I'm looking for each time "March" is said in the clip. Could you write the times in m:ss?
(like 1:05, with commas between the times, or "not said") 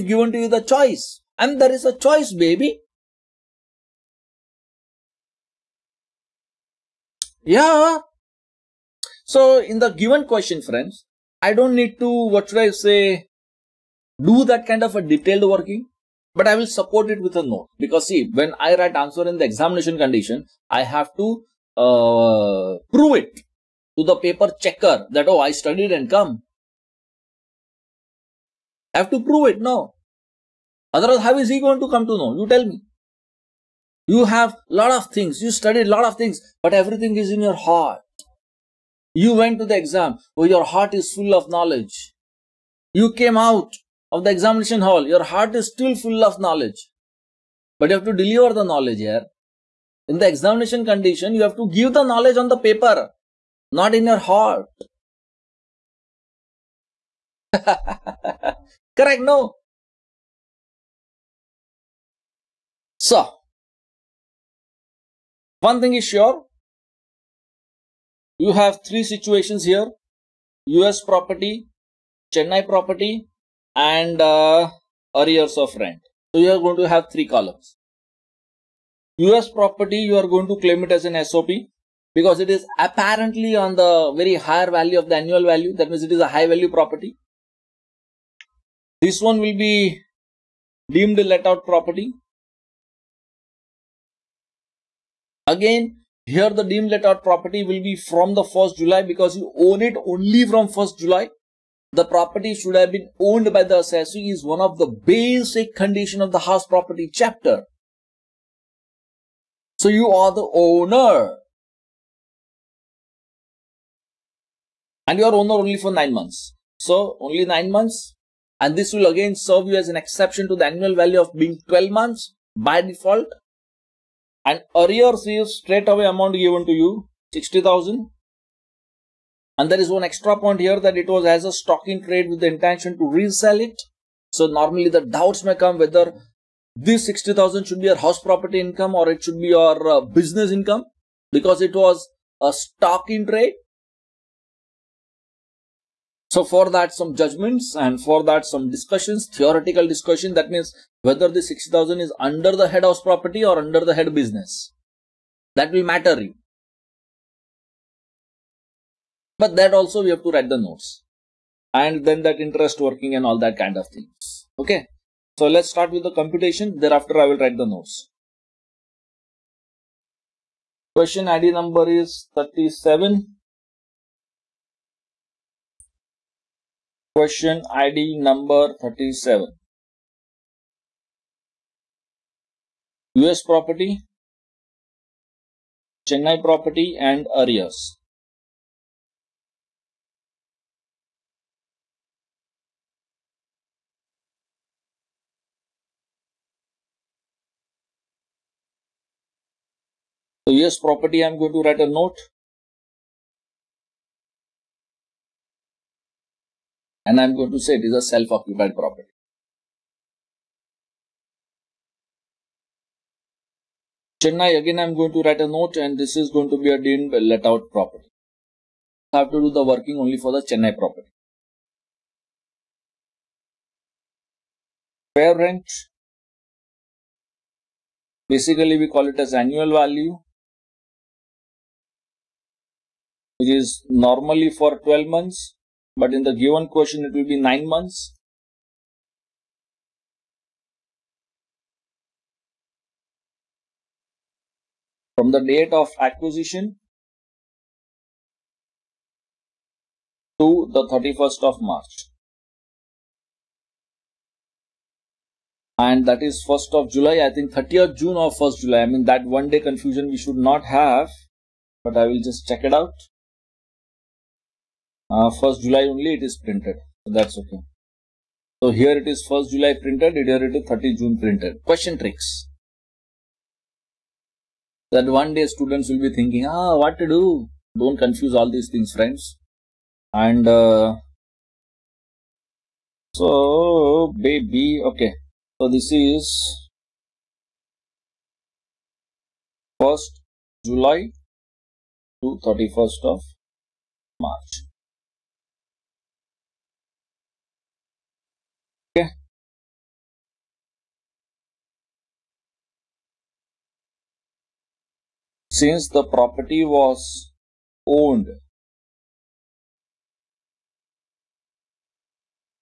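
4:11, 4:54.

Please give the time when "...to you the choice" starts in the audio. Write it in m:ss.
0:00.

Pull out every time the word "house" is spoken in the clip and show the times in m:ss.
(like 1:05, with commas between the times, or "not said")
1:46, 2:17, 2:32.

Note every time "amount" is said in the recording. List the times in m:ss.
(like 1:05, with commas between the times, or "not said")
2:06.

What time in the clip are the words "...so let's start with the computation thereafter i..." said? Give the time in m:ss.
2:45.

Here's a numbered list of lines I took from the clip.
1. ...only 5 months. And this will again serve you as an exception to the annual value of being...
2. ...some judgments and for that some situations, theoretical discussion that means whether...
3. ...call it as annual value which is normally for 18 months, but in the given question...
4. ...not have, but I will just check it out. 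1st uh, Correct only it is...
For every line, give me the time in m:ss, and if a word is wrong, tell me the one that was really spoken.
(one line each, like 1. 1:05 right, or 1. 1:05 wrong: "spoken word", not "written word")
1. 1:57 wrong: "9", not "5"
2. 2:26 wrong: "discussions", not "situations"
3. 3:48 wrong: "12", not "18"
4. 4:20 wrong: "July", not "Correct".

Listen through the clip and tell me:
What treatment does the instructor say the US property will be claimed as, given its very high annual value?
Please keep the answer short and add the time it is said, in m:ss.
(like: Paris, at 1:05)
SOP, at 1:21.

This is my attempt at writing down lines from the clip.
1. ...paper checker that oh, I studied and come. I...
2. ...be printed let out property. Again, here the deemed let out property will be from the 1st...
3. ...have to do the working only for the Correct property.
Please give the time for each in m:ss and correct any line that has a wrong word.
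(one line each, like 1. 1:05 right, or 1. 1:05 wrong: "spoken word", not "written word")
1. 0:24 right
2. 1:29 wrong: "deemed", not "printed"
3. 3:39 wrong: "Chennai", not "Correct".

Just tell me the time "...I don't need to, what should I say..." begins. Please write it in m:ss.
0:11.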